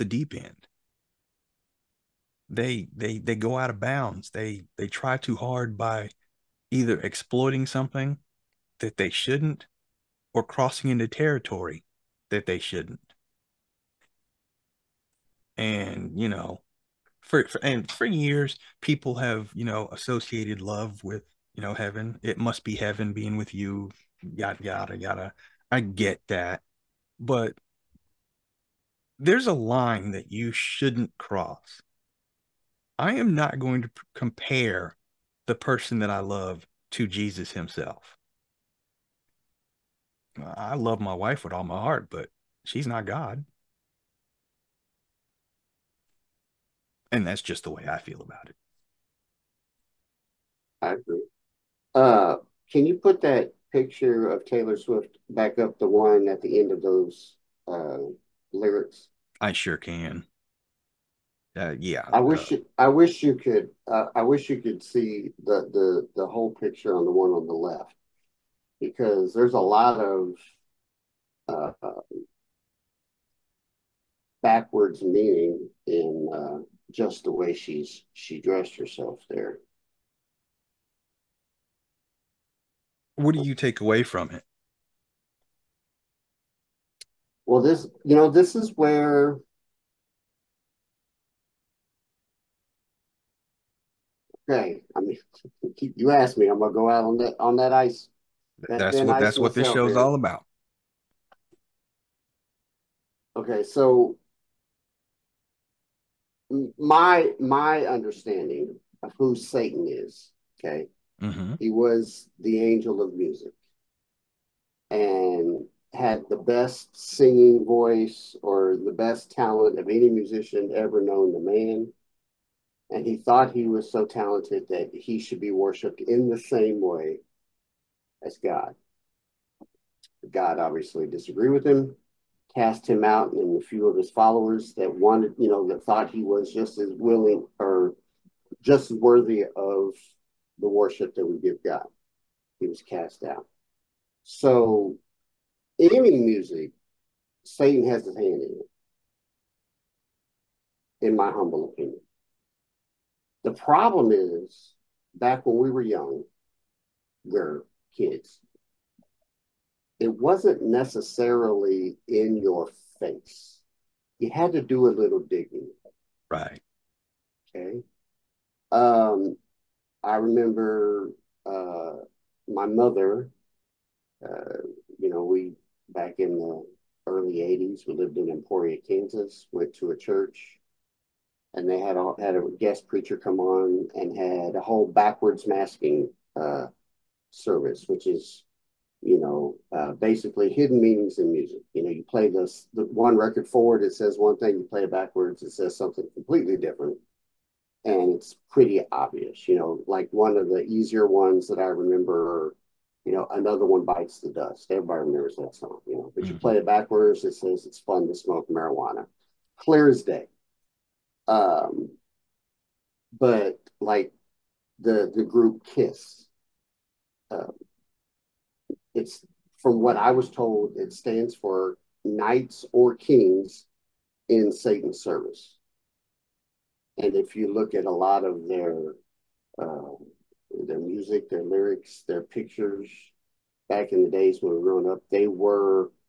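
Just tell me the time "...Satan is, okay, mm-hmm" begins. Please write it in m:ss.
1:49.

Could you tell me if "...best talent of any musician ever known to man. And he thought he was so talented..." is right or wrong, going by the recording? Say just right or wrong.
right.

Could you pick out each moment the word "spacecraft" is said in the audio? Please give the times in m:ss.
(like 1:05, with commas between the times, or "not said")
not said.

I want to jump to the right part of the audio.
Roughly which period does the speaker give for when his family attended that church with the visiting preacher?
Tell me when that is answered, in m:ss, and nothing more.
2:57.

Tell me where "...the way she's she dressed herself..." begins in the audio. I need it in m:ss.
1:17.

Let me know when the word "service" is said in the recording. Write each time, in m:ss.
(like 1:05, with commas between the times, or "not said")
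3:07, 3:45.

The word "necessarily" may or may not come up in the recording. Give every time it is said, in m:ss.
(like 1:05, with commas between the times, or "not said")
2:40.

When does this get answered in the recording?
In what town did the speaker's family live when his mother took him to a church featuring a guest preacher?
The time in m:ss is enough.
2:58.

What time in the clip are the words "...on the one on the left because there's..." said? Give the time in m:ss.
1:06.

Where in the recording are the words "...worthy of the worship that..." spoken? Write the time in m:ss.
2:18.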